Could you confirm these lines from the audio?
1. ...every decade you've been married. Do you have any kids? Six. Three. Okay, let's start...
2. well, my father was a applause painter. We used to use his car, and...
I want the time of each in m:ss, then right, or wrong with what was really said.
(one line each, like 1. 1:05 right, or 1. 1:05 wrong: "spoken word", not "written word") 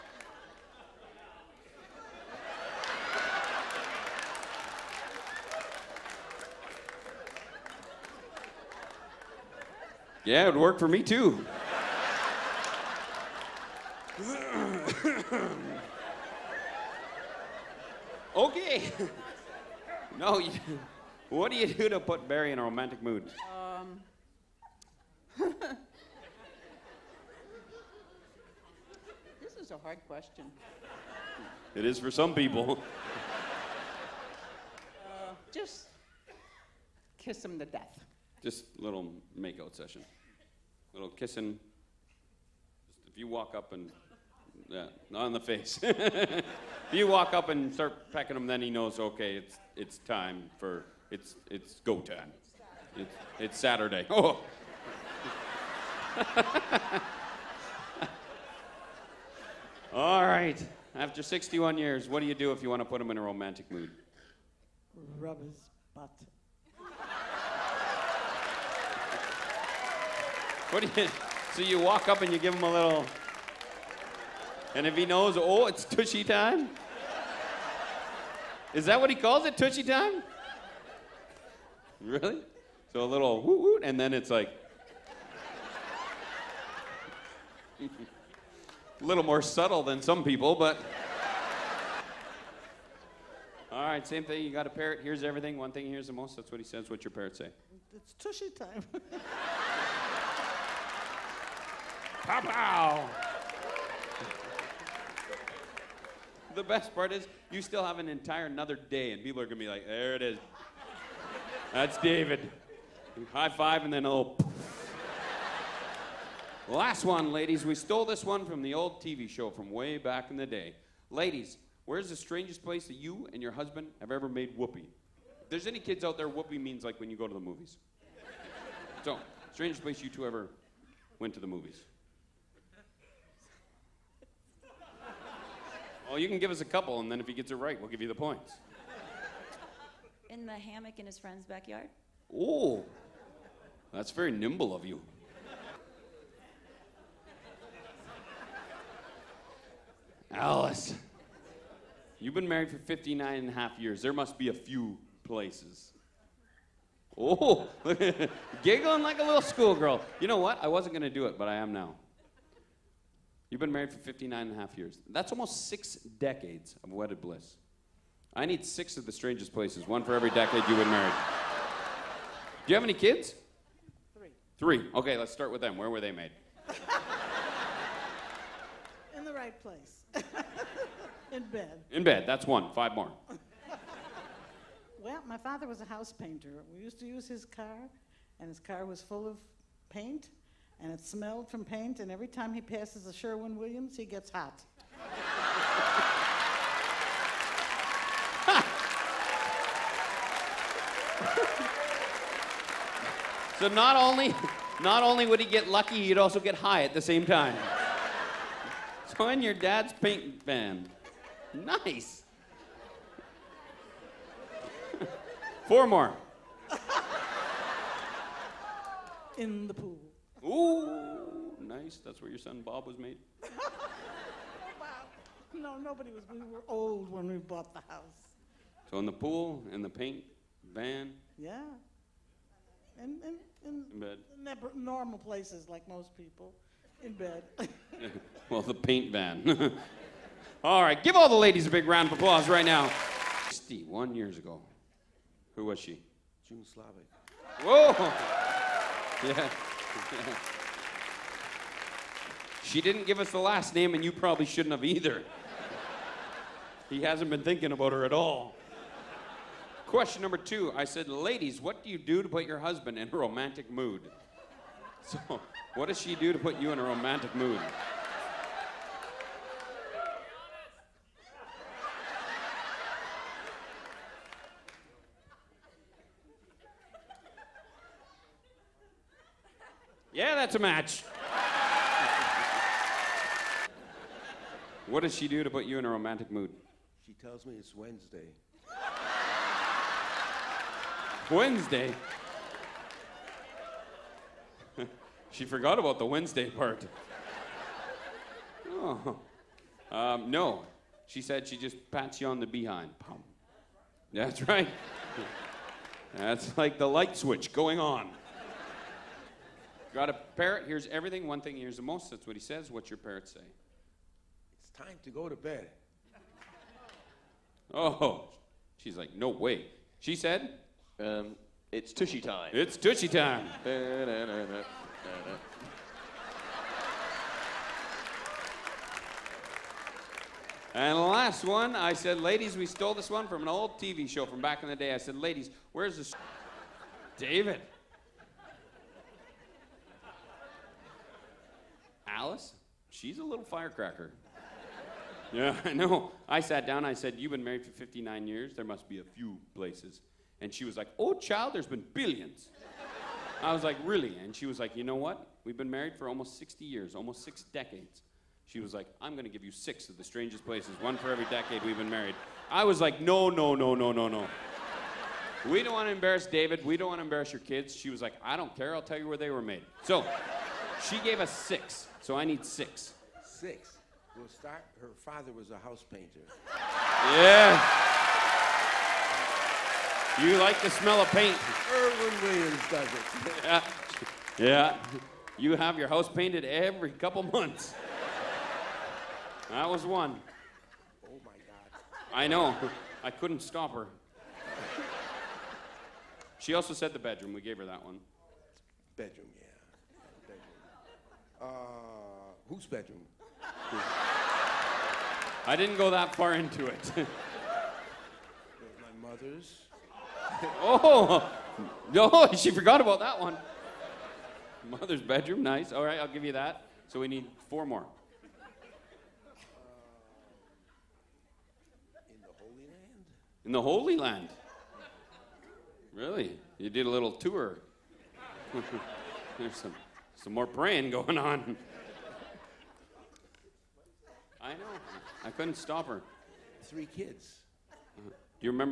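1. 2:50 wrong: "Three", not "Six"
2. 3:04 wrong: "house", not "applause".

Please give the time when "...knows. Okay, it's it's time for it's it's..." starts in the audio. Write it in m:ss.
0:48.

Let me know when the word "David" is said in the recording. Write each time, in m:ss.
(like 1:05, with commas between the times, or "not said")
1:51, 5:37, 6:06.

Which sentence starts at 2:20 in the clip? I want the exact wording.
In the hammock in his friend's backyard?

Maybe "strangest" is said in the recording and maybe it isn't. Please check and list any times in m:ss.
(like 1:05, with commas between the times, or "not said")
2:02, 2:09, 2:49, 6:00.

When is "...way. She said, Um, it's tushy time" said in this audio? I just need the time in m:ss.
5:19.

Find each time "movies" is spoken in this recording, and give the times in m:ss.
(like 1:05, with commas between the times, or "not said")
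2:07, 2:11.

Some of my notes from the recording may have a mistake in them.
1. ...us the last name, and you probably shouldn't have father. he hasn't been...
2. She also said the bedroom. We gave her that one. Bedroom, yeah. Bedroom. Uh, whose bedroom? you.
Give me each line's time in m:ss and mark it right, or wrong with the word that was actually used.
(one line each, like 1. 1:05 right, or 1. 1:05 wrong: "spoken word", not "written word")
1. 4:13 wrong: "either", not "father"
2. 6:36 right.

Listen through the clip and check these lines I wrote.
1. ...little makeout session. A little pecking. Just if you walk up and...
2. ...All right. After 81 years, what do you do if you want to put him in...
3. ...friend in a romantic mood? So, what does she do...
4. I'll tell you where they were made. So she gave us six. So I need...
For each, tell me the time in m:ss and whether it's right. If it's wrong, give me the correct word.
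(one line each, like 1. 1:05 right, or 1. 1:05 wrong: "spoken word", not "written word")
1. 0:38 wrong: "kissing", not "pecking"
2. 0:59 wrong: "61", not "81"
3. 4:22 wrong: "husband", not "friend"
4. 6:08 right.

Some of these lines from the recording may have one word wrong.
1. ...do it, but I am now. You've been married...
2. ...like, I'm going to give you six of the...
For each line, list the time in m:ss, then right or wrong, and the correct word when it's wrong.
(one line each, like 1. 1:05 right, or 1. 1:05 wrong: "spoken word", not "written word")
1. 2:41 right
2. 5:58 right.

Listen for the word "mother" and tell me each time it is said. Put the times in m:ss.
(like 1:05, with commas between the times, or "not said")
6:49, 6:54.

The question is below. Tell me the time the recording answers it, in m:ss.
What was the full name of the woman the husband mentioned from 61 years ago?
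4:06.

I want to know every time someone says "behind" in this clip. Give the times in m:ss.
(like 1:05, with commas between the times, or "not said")
5:02.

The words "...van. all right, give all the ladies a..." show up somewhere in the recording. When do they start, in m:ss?
3:59.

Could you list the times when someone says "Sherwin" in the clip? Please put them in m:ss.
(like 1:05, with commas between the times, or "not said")
3:13, 6:21.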